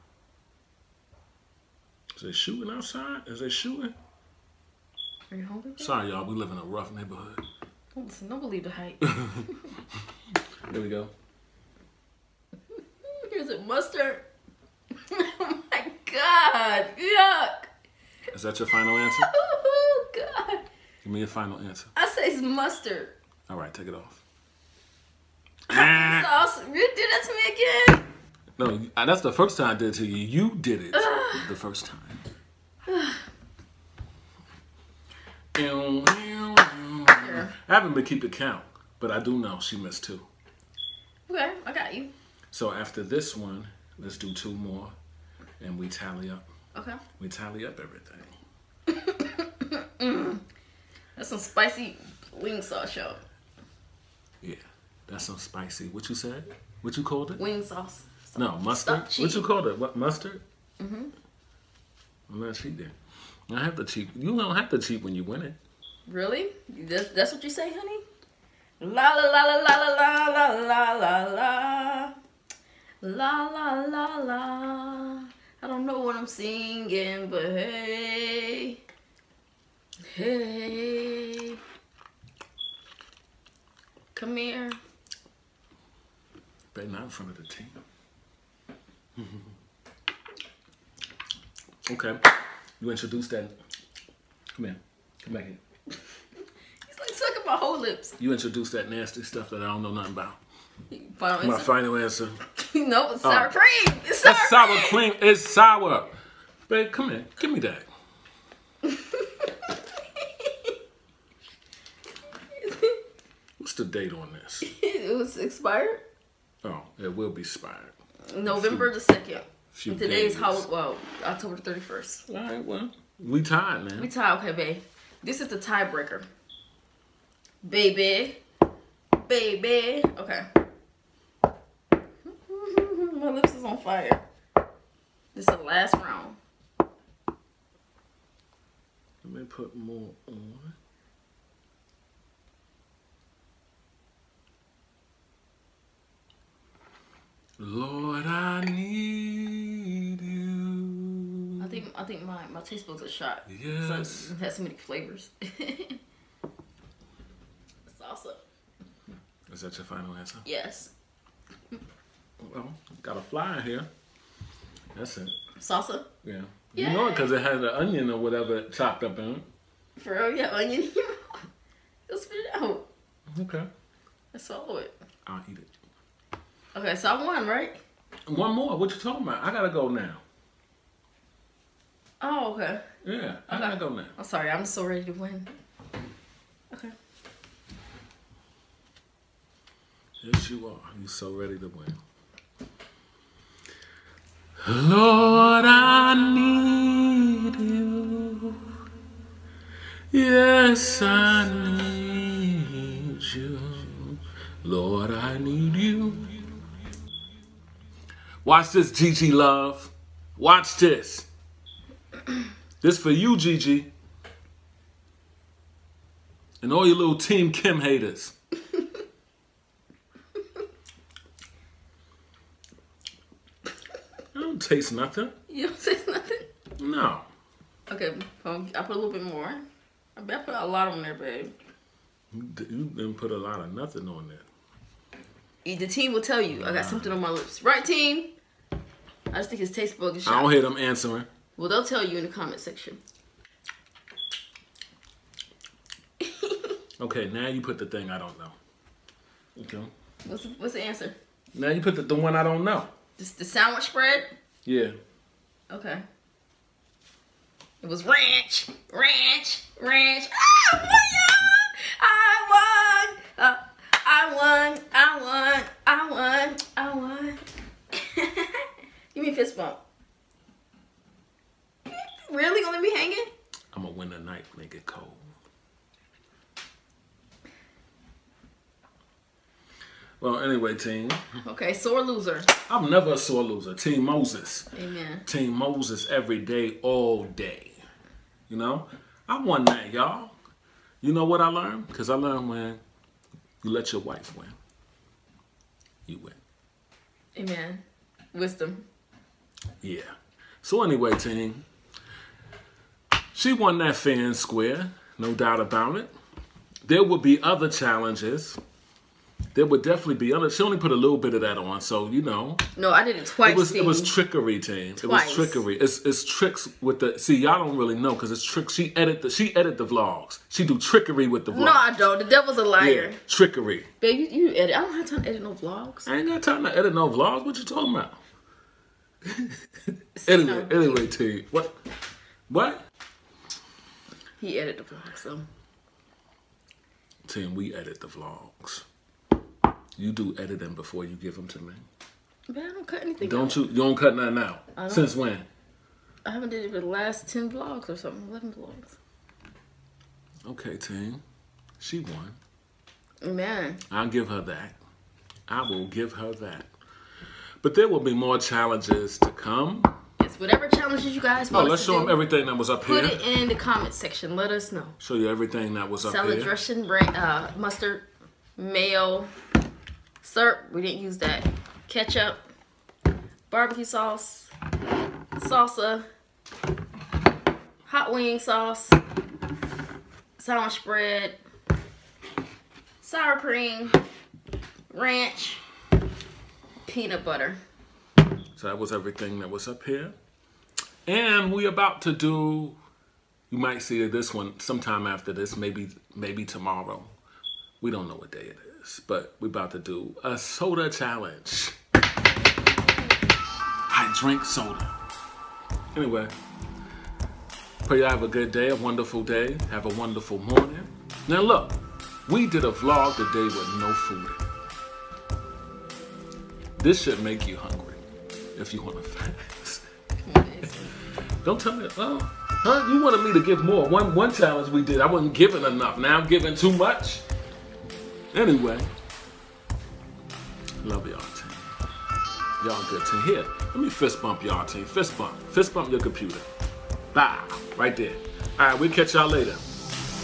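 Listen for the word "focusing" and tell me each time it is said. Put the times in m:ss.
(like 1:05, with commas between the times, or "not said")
not said.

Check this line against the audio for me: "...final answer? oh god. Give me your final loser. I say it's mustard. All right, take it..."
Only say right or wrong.
wrong.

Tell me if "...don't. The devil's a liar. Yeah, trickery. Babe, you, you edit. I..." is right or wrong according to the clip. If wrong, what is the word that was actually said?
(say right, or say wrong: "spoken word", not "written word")
right.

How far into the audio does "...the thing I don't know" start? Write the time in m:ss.
4:07.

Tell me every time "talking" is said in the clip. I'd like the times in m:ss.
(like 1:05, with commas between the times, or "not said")
2:58, 5:27.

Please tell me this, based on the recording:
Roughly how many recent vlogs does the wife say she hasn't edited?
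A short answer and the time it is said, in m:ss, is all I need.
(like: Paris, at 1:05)
11, at 5:48.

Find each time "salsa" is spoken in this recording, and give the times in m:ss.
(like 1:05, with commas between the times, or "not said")
2:37, 2:45, 6:15.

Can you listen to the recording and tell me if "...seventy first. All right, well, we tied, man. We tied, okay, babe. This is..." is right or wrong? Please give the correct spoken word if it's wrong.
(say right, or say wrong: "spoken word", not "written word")
wrong: "thirty", not "seventy".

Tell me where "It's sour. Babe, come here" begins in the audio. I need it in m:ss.
1:45.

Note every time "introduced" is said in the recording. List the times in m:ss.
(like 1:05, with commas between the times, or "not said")
1:32, 1:38.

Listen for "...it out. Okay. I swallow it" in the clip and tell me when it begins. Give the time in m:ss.
2:52.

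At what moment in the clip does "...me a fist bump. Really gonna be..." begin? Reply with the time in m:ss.
4:29.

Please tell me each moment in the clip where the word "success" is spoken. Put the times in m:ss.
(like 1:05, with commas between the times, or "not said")
not said.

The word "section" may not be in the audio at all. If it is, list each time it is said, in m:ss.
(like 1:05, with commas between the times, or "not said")
4:02, 6:03.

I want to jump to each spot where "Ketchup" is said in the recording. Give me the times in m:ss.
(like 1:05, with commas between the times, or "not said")
6:11.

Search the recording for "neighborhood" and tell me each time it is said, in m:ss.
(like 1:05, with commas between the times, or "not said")
0:06.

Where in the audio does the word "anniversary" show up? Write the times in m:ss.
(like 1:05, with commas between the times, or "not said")
not said.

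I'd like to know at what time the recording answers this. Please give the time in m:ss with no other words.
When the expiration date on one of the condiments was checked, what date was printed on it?
1:58.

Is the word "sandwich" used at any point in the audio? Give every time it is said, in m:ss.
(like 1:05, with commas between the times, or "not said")
4:13, 6:20.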